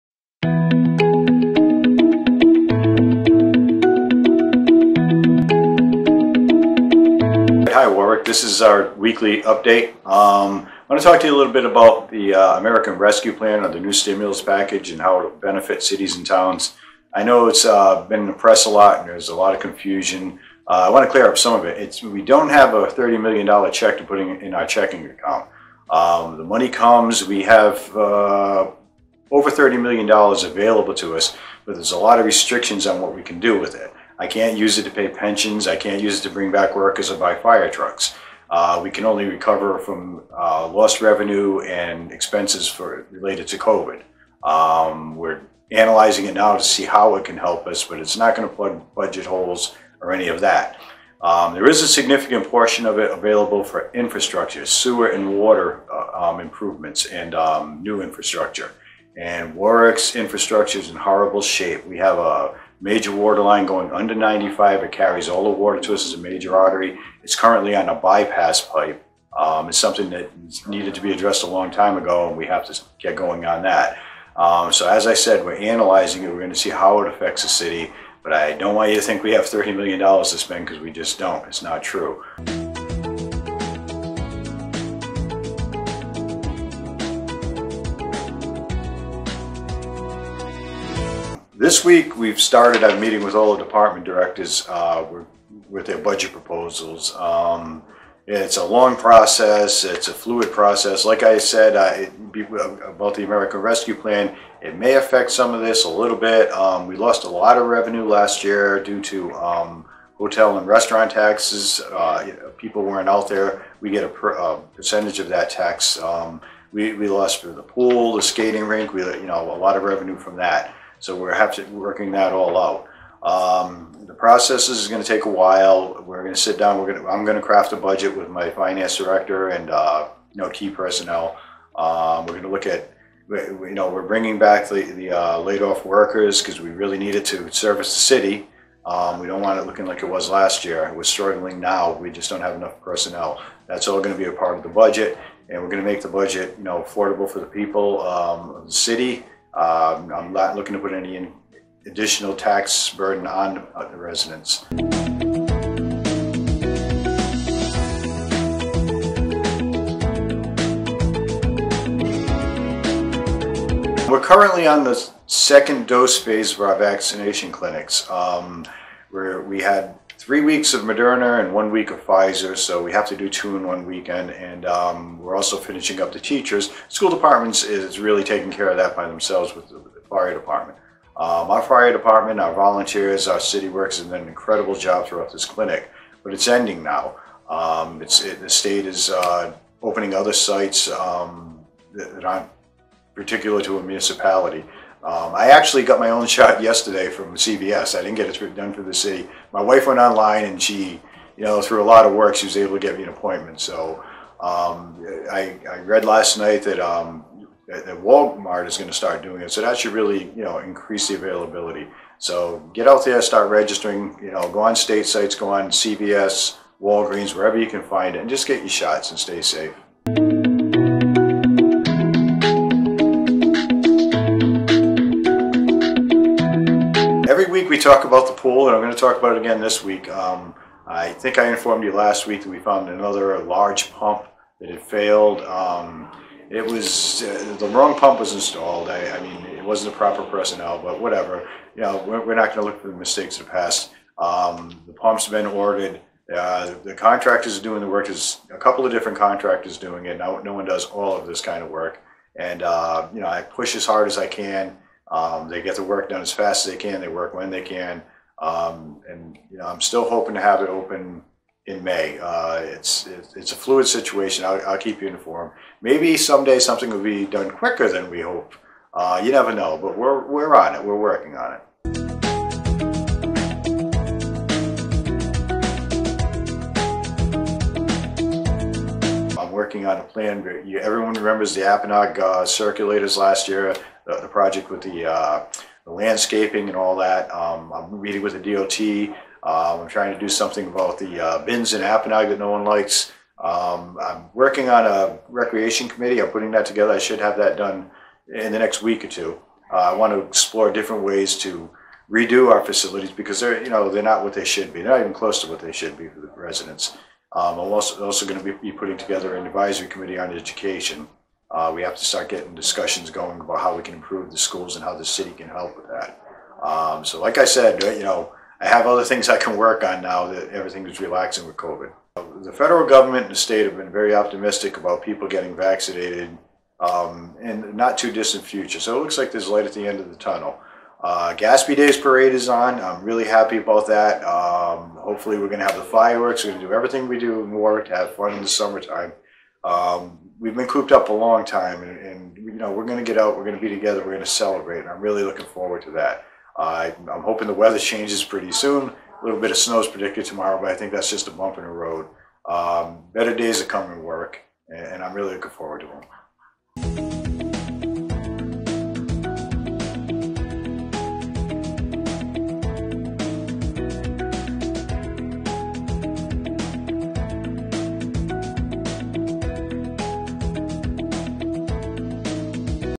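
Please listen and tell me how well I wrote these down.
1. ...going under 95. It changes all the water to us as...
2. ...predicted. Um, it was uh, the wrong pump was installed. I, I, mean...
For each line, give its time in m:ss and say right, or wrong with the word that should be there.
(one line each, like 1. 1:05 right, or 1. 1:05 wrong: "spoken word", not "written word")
1. 1:03 wrong: "carries", not "changes"
2. 3:54 wrong: "failed", not "predicted".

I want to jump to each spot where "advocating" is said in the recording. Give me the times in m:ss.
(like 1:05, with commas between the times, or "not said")
not said.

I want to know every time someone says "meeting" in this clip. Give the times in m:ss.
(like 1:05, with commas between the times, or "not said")
1:32, 4:48.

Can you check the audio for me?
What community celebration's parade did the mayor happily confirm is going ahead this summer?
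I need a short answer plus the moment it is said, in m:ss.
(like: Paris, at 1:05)
Gaspee Days, at 5:31.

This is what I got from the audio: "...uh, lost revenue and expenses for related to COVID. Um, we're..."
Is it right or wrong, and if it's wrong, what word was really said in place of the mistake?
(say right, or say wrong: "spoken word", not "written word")
right.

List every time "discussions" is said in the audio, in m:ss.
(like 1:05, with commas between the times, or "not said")
5:12.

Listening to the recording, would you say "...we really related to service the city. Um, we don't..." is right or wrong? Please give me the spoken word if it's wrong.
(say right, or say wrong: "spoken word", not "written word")
wrong: "needed", not "related".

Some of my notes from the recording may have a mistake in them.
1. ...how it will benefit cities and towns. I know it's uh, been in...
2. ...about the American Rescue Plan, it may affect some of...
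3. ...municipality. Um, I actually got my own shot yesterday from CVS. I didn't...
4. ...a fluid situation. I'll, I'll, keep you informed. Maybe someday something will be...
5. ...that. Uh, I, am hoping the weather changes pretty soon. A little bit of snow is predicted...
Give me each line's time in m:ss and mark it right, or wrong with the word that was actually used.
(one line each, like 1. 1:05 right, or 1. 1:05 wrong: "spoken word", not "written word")
1. 0:15 right
2. 1:42 right
3. 3:13 right
4. 4:23 right
5. 5:45 right.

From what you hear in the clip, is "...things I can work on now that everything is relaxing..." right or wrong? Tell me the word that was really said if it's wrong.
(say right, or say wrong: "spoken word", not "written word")
right.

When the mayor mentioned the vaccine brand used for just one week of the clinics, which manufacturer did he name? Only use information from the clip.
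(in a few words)
Pfizer.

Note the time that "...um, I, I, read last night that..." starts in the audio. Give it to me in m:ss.
3:24.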